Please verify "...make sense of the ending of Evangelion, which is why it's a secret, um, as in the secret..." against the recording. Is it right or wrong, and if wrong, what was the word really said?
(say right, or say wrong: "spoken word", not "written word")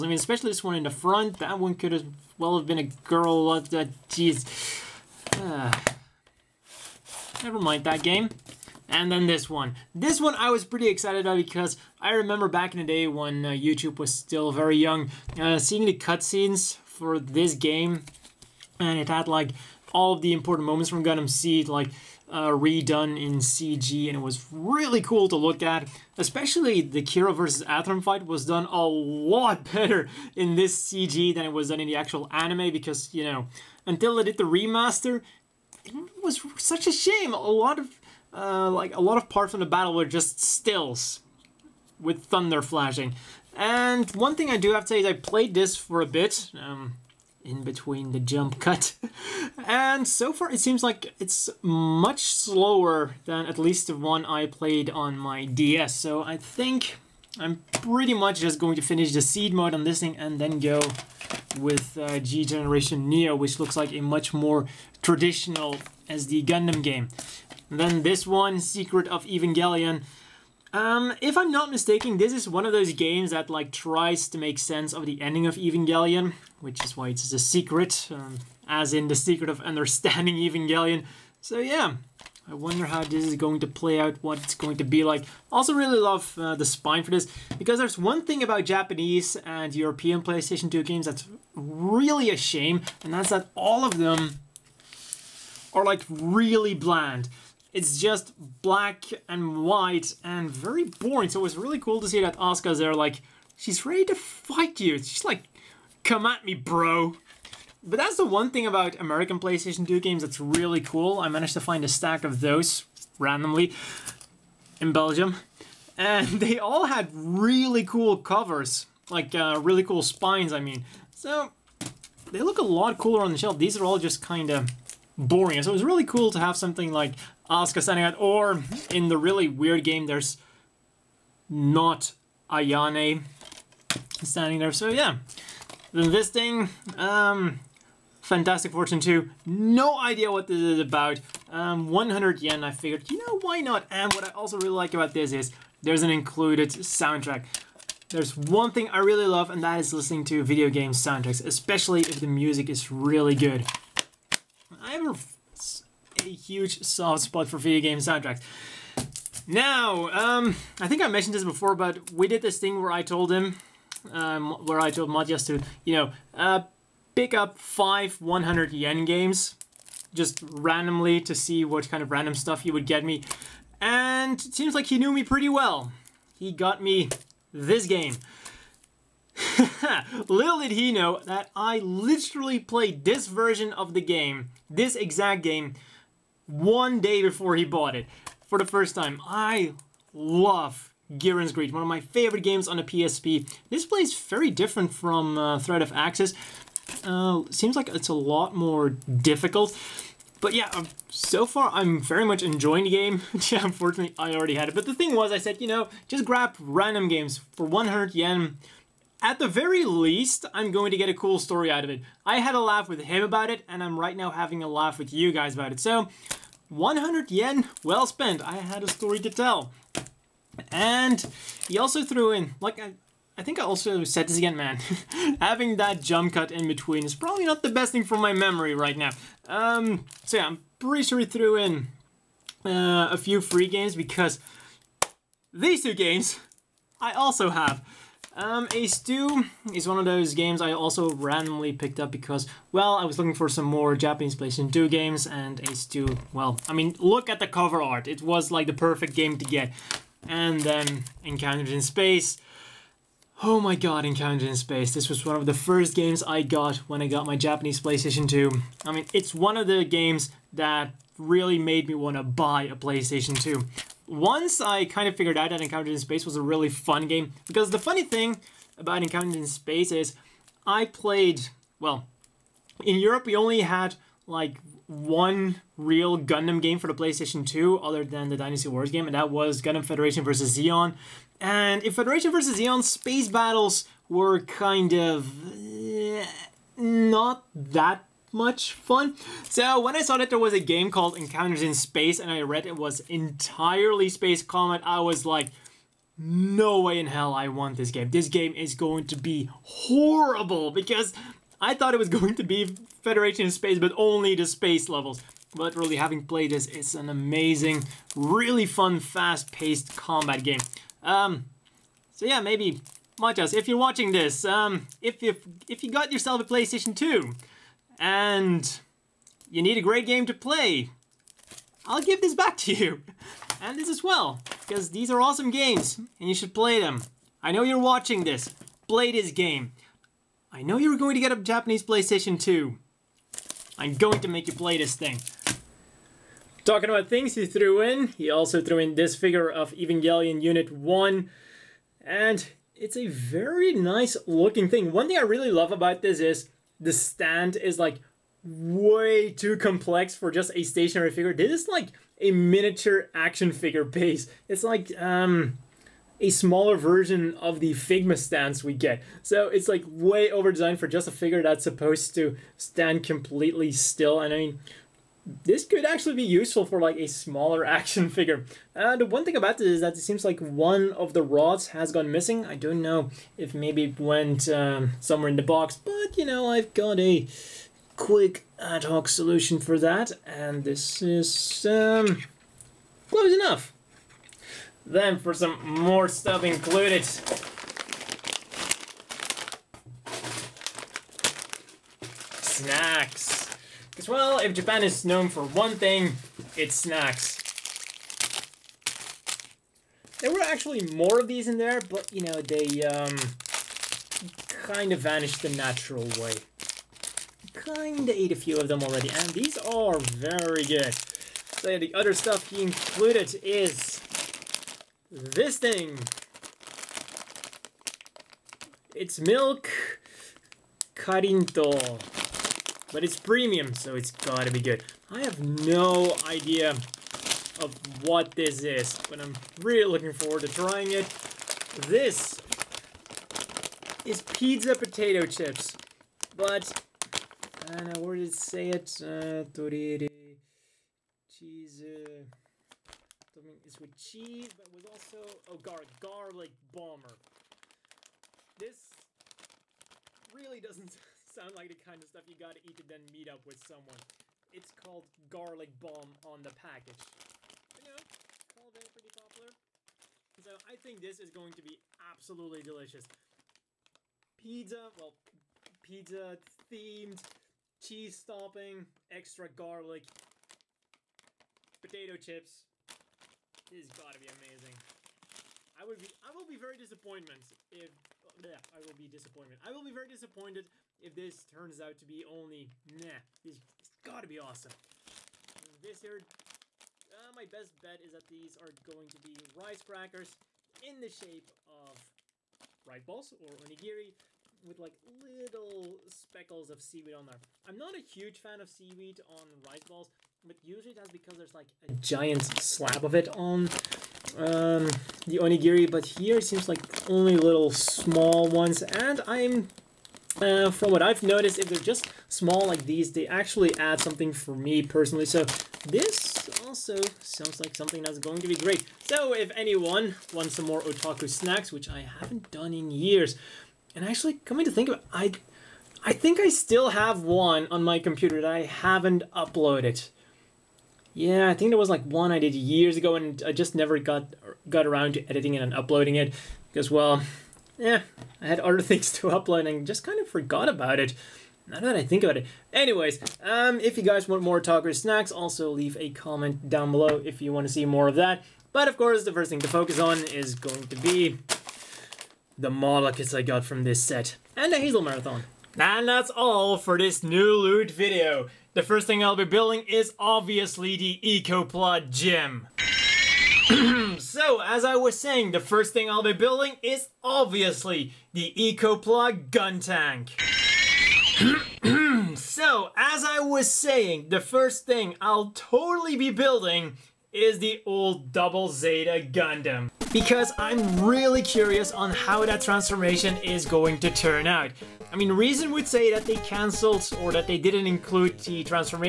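right.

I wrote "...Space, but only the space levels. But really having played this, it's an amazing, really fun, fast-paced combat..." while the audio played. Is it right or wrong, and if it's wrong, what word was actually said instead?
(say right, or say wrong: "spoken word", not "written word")
right.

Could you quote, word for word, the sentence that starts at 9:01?
Now that I think about it.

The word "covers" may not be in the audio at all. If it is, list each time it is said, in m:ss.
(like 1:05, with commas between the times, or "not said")
1:58, 4:07.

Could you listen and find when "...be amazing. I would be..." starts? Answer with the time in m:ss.
7:54.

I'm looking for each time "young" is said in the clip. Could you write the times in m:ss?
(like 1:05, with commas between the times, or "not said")
0:14.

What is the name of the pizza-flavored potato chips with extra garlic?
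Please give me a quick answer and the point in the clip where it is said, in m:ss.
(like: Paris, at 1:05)
Garlic bomb, at 7:35.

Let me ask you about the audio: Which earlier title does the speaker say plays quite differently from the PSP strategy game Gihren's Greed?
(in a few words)
Threat of Axis.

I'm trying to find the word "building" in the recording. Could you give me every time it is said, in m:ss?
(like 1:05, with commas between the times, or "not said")
9:19, 9:26, 9:36.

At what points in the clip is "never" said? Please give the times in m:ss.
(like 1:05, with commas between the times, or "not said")
0:07, 8:53.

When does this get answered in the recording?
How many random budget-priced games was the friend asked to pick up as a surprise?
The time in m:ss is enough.
2:47.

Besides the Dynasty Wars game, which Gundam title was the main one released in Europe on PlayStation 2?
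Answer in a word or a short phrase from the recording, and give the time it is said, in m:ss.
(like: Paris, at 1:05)
Gundam Federation vs. Zeon, at 4:39.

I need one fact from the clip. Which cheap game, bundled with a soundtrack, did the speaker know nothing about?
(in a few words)
Fantastic Fortune 2.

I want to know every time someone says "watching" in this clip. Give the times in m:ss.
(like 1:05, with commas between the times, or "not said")
5:13, 5:27.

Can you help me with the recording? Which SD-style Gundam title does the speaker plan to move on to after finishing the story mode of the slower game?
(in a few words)
G Generation Neo.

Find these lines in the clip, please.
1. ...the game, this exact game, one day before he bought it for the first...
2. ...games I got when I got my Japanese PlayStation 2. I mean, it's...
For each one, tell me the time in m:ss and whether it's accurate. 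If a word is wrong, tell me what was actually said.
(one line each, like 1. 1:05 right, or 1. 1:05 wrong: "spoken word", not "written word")
1. 3:03 right
2. 4:15 right.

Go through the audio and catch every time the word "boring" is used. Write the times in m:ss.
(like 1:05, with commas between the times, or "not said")
1:40, 2:05.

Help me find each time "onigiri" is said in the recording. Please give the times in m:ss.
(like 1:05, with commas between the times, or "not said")
8:13, 8:25.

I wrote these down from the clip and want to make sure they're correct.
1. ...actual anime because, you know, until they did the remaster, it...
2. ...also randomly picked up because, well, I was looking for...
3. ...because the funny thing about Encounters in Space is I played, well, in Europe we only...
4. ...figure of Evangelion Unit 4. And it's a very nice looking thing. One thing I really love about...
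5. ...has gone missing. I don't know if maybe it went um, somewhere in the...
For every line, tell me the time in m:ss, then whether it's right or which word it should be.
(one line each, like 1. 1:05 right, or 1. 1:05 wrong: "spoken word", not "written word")
1. 0:31 right
2. 4:00 right
3. 4:27 right
4. 5:39 wrong: "1", not "4"
5. 6:11 right.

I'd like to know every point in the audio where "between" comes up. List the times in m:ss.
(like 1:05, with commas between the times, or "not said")
0:47, 3:46.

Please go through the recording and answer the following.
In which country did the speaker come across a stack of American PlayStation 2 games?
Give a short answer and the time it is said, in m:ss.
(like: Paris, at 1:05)
Belgium, at 1:54.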